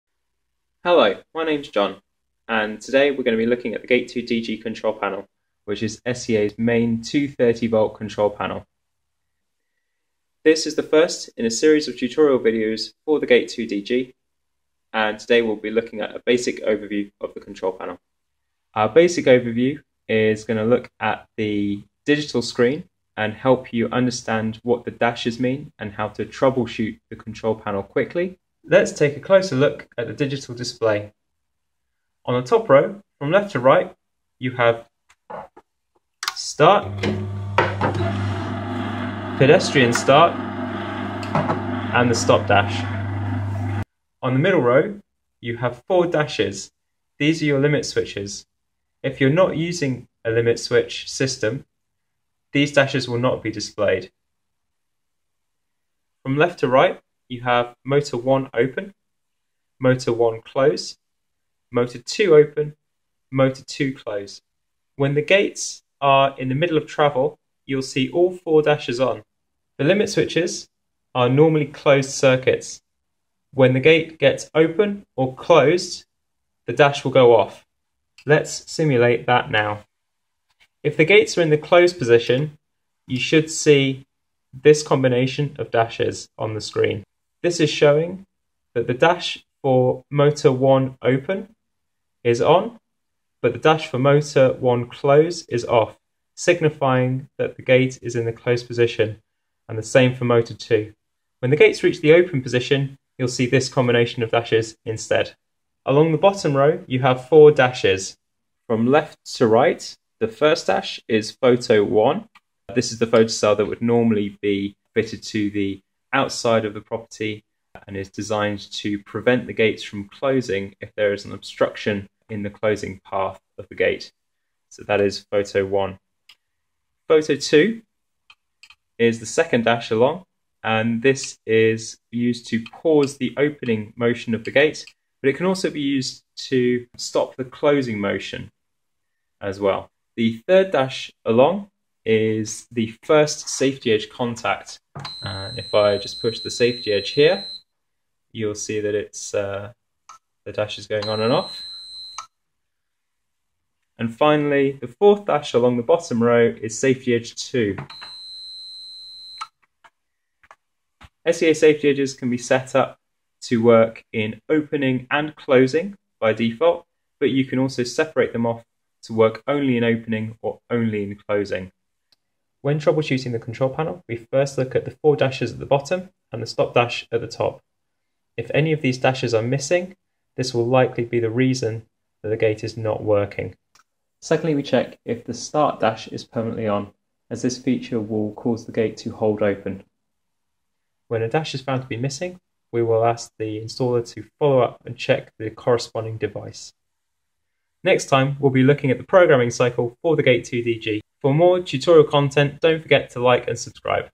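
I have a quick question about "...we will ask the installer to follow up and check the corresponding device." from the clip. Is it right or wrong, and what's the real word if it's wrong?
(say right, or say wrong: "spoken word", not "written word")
right.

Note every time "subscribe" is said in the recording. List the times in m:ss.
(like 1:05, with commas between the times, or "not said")
3:23.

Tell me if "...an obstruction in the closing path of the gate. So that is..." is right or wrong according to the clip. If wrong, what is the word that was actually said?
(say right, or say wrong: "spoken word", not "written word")
right.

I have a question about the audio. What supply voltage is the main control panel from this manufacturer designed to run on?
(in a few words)
230 volt.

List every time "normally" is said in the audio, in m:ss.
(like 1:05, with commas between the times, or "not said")
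1:11, 1:53.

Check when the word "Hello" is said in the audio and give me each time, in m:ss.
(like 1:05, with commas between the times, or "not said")
0:00.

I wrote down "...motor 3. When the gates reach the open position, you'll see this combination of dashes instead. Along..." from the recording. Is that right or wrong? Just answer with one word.
wrong.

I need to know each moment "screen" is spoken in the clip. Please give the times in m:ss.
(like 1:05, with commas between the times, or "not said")
0:22, 1:26.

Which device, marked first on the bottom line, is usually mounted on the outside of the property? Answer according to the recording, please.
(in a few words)
Photo 1.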